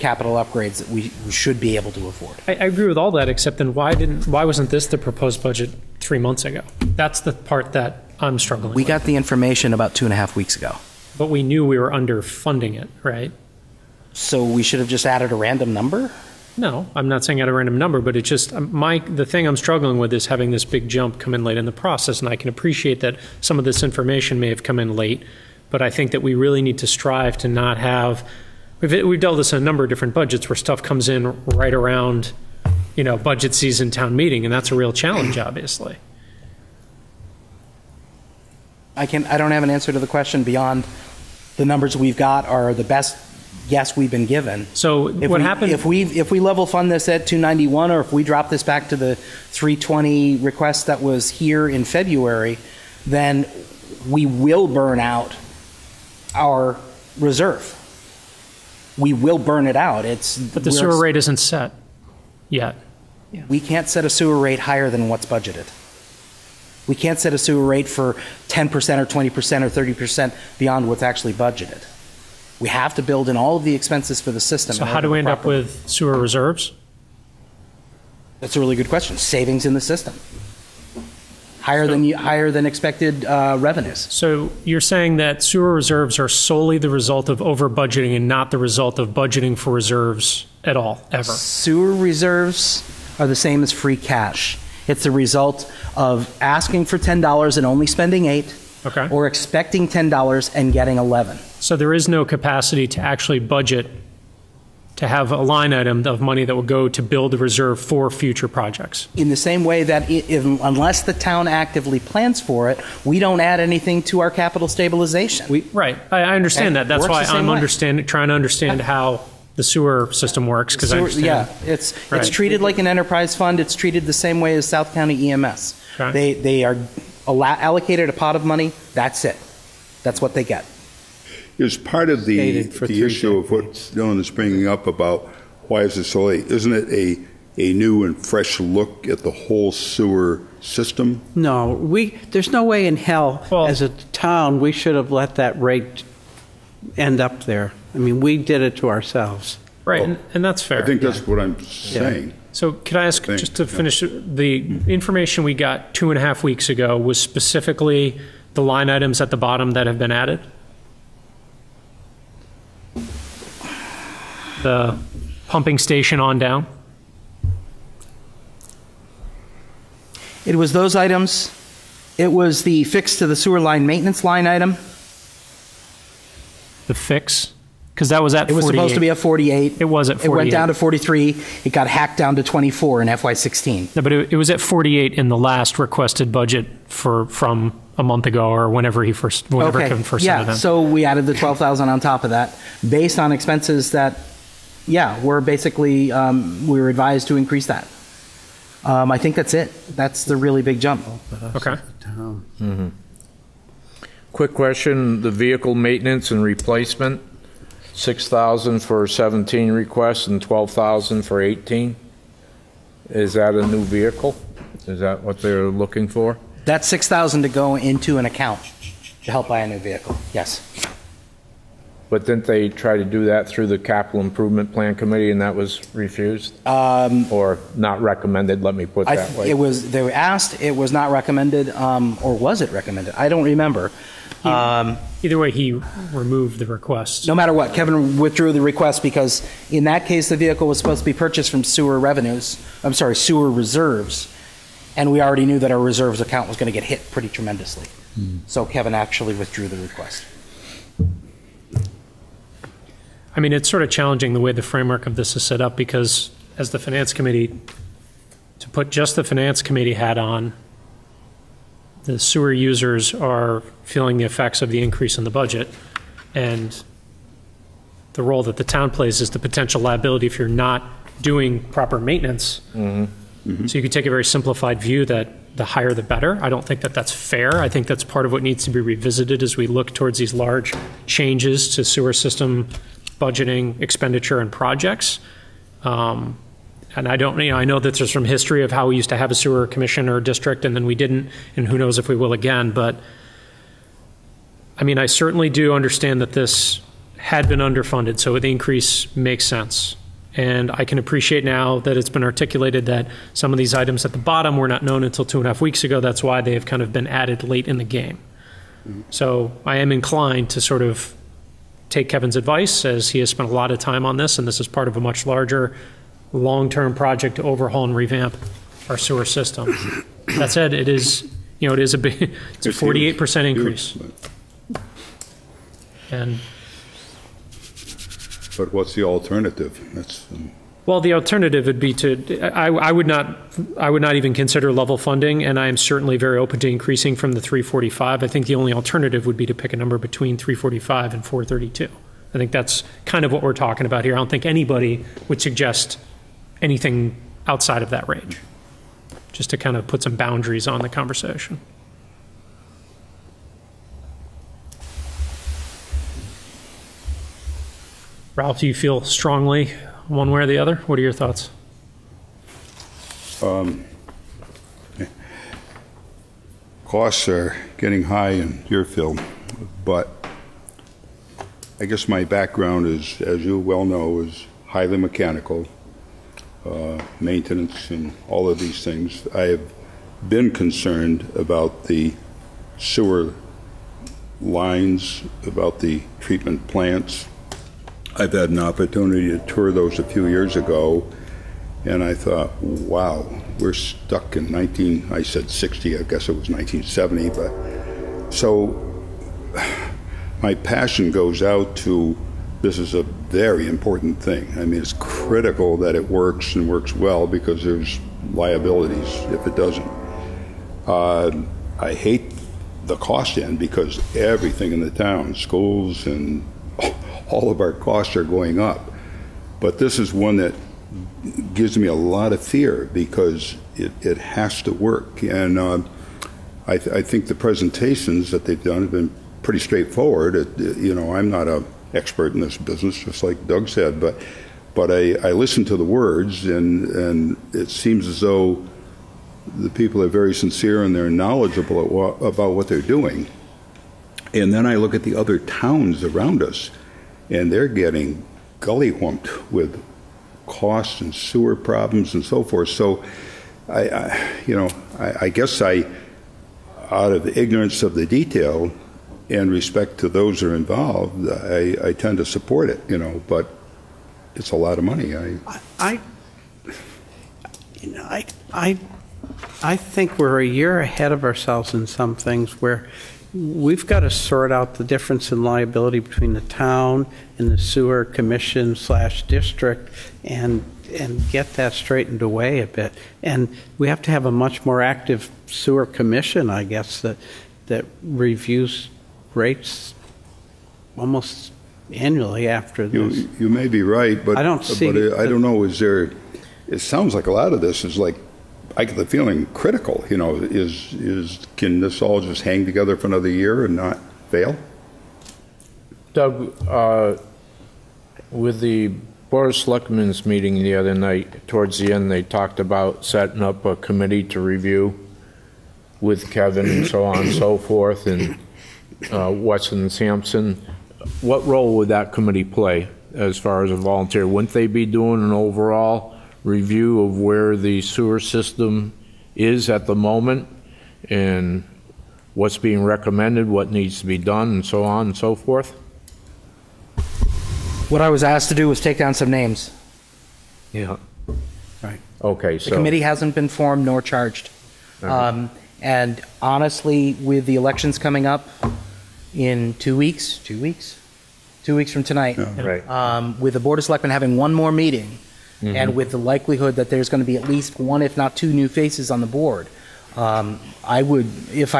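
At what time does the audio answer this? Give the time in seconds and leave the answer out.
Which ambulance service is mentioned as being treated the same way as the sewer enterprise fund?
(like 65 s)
124 s.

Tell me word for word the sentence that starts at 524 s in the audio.
Wouldn't they be doing an overall?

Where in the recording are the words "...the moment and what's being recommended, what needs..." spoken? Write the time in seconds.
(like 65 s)
529 s.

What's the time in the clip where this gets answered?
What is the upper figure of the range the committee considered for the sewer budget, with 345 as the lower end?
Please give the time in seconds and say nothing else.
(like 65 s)
341 s.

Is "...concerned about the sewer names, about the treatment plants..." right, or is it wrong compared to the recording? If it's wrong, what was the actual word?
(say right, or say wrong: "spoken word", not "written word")
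wrong: "lines", not "names".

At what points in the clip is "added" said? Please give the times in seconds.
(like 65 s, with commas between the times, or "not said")
15 s, 160 s, 191 s, 307 s.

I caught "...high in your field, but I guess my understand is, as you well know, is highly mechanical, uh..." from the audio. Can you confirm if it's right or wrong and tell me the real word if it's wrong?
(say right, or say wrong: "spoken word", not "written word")
wrong: "background", not "understand".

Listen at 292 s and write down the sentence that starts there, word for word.
But I mean, I certainly do understand that this had been underfunded, so the increase makes sense.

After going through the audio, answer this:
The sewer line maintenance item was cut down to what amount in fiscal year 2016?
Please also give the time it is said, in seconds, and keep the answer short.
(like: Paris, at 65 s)
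24, at 182 s.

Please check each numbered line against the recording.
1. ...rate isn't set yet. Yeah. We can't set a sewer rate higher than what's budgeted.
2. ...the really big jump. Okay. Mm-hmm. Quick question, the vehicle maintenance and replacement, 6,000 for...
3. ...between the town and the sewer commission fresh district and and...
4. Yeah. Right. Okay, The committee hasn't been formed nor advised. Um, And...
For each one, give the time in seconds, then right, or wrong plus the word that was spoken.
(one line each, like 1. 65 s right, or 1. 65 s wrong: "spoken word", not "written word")
1. 60 s right
2. 200 s right
3. 475 s wrong: "slash", not "fresh"
4. 540 s wrong: "charged", not "advised".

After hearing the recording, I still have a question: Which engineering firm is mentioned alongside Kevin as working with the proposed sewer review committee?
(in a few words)
Weston and Sampson.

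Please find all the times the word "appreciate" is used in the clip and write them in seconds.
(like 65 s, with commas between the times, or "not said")
22 s, 300 s.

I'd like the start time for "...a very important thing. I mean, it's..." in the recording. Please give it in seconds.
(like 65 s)
402 s.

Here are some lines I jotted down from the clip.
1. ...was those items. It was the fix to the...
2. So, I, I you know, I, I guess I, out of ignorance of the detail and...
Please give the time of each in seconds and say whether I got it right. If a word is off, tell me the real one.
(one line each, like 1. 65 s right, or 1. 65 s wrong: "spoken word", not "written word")
1. 170 s right
2. 452 s right.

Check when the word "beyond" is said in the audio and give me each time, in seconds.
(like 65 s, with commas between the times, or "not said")
40 s, 70 s.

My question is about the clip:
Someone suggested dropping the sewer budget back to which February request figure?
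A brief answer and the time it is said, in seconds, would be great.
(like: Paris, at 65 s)
320, at 49 s.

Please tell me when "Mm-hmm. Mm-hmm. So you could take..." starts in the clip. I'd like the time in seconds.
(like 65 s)
272 s.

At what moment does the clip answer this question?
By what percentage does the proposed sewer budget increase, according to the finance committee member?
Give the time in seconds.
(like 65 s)
322 s.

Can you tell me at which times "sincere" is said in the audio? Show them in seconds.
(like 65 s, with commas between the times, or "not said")
440 s.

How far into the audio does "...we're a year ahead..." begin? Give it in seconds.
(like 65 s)
470 s.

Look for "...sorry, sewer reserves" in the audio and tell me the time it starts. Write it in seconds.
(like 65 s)
242 s.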